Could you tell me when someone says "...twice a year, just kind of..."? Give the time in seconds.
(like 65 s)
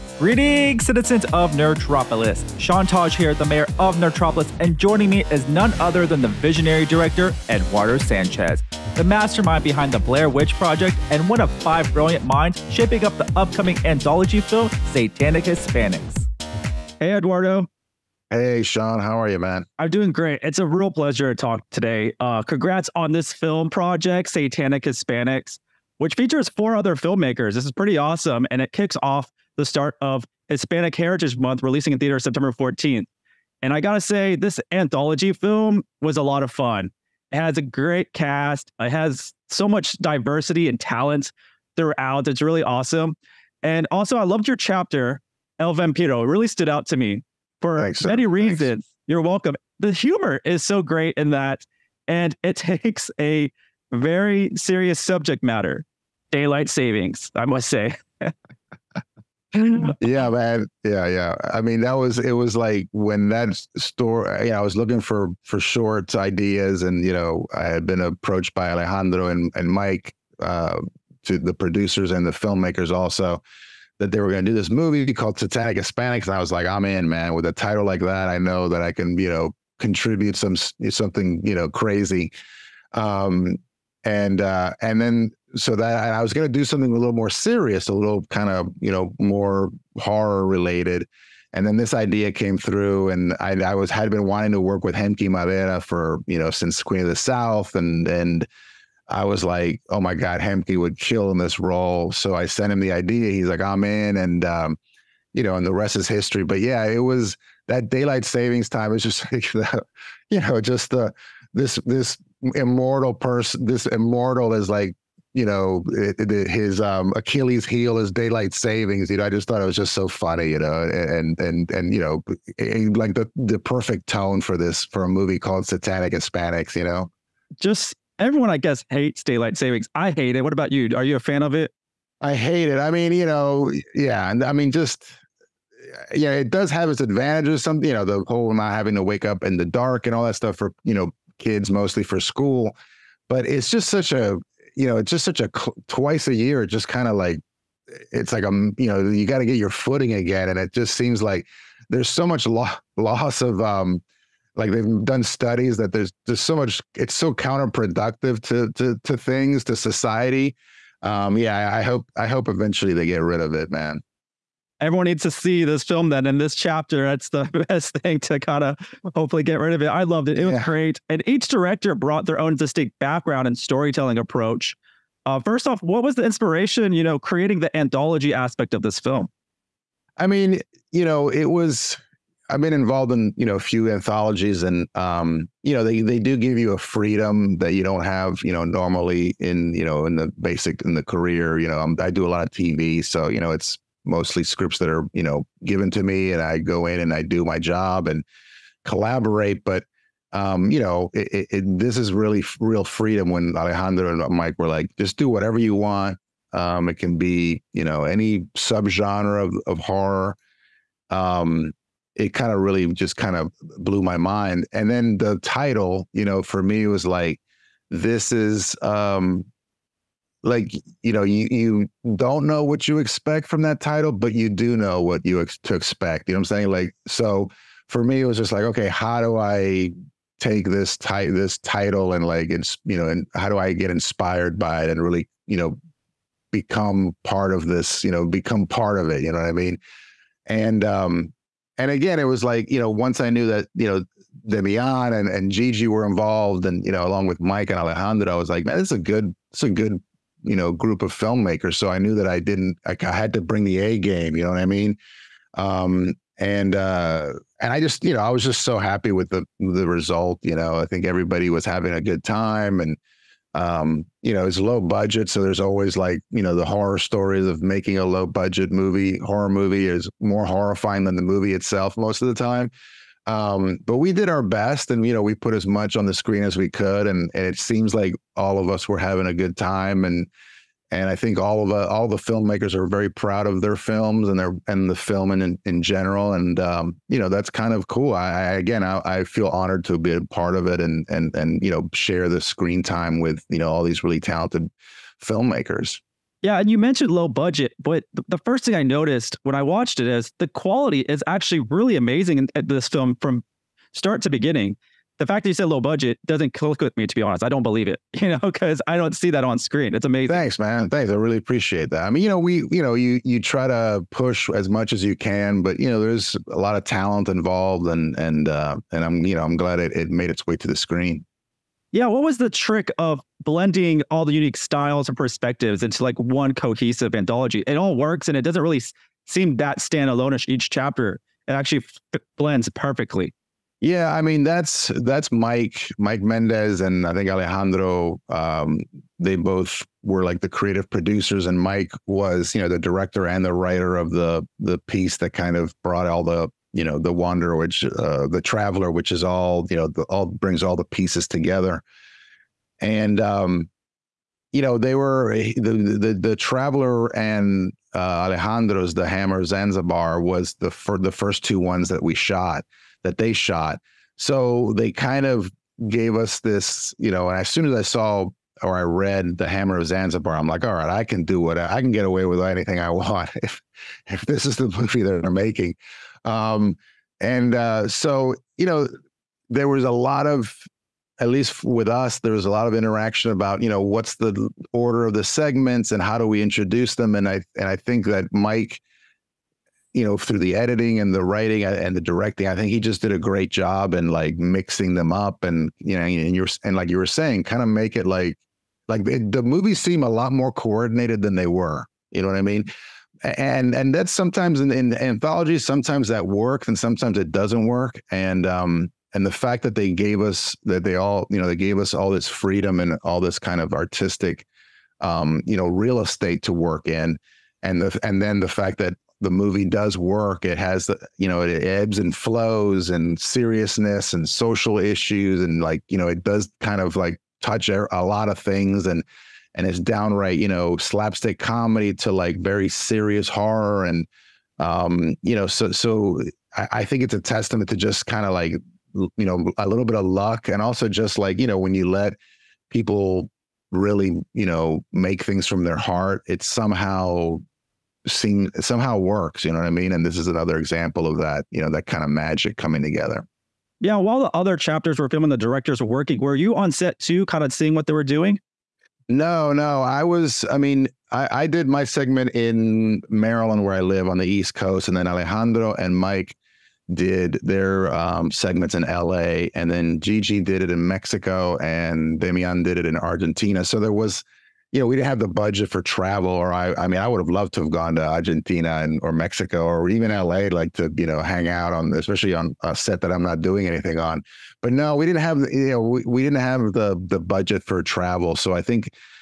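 145 s.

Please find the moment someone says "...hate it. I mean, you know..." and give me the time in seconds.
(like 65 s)
132 s.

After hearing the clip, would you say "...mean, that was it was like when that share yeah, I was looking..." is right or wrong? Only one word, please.
wrong.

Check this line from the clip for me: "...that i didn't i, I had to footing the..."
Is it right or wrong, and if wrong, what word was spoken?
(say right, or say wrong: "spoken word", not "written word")
wrong: "bring", not "footing".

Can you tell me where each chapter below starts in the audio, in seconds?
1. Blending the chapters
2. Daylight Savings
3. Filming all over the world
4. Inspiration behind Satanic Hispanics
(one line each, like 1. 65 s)
1. 325 s
2. 37 s
3. 453 s
4. 171 s.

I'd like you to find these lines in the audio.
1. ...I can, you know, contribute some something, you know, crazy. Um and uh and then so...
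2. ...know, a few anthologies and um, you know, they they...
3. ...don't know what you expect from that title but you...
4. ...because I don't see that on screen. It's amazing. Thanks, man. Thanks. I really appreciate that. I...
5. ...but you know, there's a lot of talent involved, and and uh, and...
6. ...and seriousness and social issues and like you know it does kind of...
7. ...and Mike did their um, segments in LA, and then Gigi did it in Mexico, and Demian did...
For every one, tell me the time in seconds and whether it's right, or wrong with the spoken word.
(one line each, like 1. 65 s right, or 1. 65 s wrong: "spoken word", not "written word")
1. 78 s right
2. 183 s right
3. 222 s right
4. 308 s right
5. 315 s right
6. 422 s right
7. 465 s right.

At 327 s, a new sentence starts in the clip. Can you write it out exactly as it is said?
It all works and it doesn't really seem that standalone each chapter.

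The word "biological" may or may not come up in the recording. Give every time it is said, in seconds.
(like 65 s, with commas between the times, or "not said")
not said.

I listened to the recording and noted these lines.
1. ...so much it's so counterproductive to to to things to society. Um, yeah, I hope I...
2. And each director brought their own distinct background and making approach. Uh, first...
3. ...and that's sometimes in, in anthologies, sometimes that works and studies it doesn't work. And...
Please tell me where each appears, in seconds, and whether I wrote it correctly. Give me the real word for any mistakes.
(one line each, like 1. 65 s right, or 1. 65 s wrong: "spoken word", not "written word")
1. 156 s right
2. 171 s wrong: "storytelling", not "making"
3. 403 s wrong: "sometimes", not "studies".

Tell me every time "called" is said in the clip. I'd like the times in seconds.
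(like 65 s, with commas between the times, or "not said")
75 s, 125 s.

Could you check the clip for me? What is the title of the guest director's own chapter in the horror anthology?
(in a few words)
El Vampiro.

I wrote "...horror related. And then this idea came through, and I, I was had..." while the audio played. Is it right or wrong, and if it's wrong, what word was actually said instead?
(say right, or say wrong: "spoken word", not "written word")
right.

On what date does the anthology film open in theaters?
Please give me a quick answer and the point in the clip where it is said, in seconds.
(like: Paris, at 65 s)
September 14th, at 32 s.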